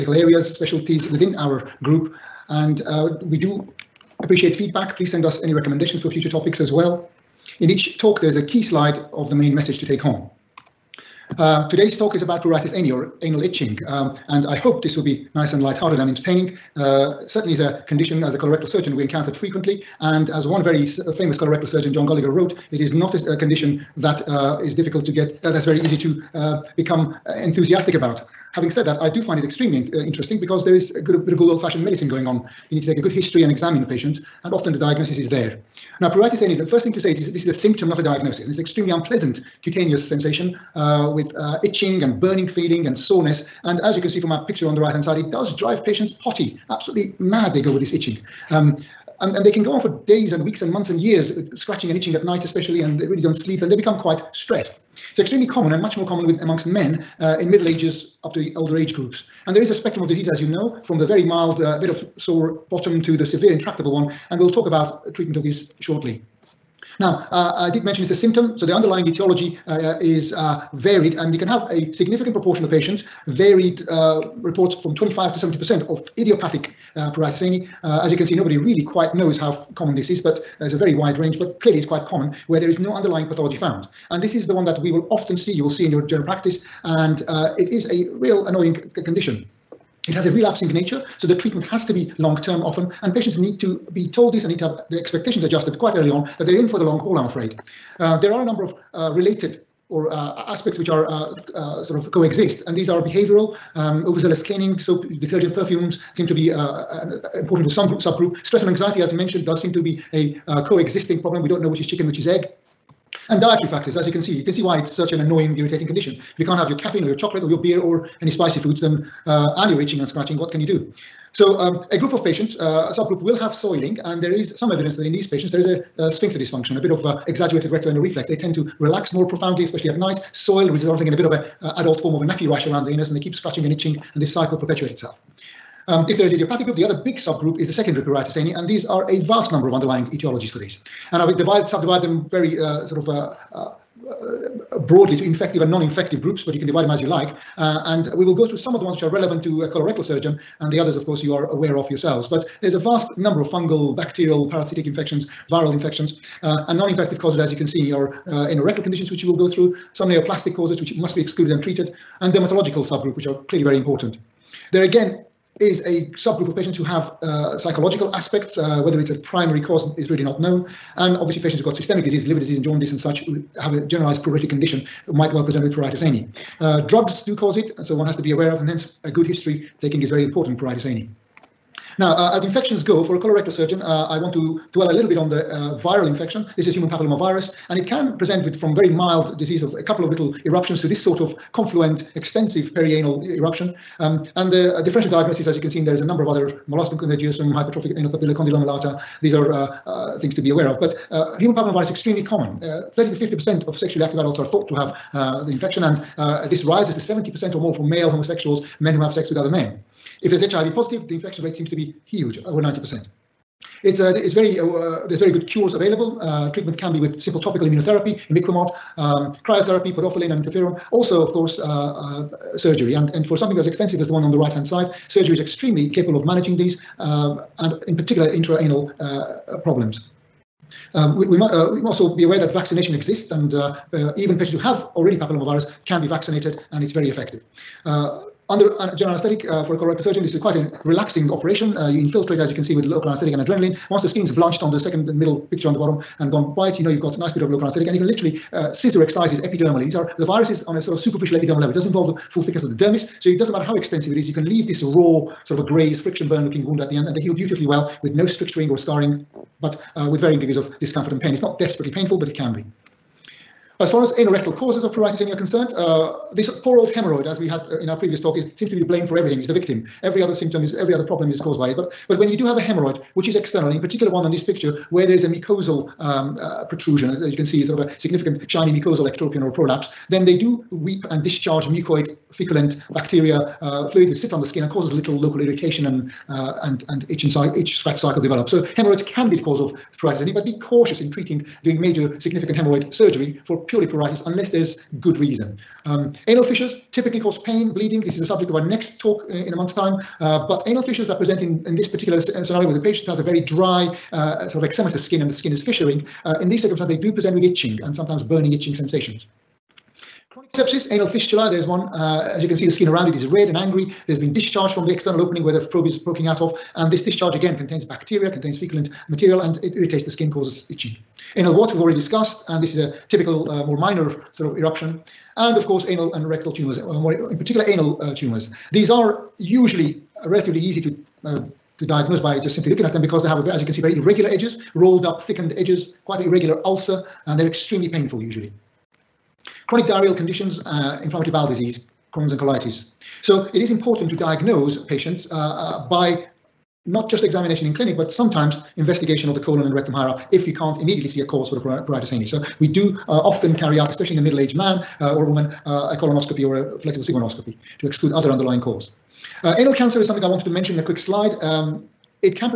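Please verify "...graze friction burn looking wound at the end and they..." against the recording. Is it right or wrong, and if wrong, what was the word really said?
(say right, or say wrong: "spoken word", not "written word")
right.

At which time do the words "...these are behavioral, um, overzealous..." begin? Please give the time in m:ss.
1:42.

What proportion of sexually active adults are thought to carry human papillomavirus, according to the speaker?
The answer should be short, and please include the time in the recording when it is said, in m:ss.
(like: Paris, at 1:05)
30 to 50%, at 3:22.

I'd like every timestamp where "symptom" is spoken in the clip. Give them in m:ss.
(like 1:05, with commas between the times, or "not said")
0:37, 1:08, 4:30.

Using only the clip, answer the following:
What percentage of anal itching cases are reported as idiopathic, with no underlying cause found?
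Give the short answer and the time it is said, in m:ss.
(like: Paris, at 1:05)
25 to 70%, at 1:14.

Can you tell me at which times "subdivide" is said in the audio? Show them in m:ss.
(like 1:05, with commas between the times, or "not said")
2:21.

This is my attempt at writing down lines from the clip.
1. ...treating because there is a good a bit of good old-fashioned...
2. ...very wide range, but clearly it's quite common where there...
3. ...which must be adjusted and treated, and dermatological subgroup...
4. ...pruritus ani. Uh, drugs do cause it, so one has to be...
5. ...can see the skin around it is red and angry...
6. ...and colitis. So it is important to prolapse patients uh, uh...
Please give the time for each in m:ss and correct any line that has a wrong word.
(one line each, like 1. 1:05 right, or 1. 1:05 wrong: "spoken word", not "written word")
1. 0:30 wrong: "interesting", not "treating"
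2. 1:20 right
3. 2:40 wrong: "excluded", not "adjusted"
4. 2:55 right
5. 5:12 right
6. 5:42 wrong: "diagnose", not "prolapse".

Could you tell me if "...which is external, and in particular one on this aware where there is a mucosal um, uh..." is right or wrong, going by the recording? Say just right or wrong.
wrong.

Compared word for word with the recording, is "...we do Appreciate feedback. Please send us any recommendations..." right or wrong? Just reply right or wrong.
right.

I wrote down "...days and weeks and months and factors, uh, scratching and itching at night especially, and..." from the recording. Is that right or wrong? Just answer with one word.
wrong.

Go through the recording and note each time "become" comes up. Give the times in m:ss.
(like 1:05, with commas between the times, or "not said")
0:26, 0:53.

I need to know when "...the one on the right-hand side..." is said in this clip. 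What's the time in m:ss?
3:44.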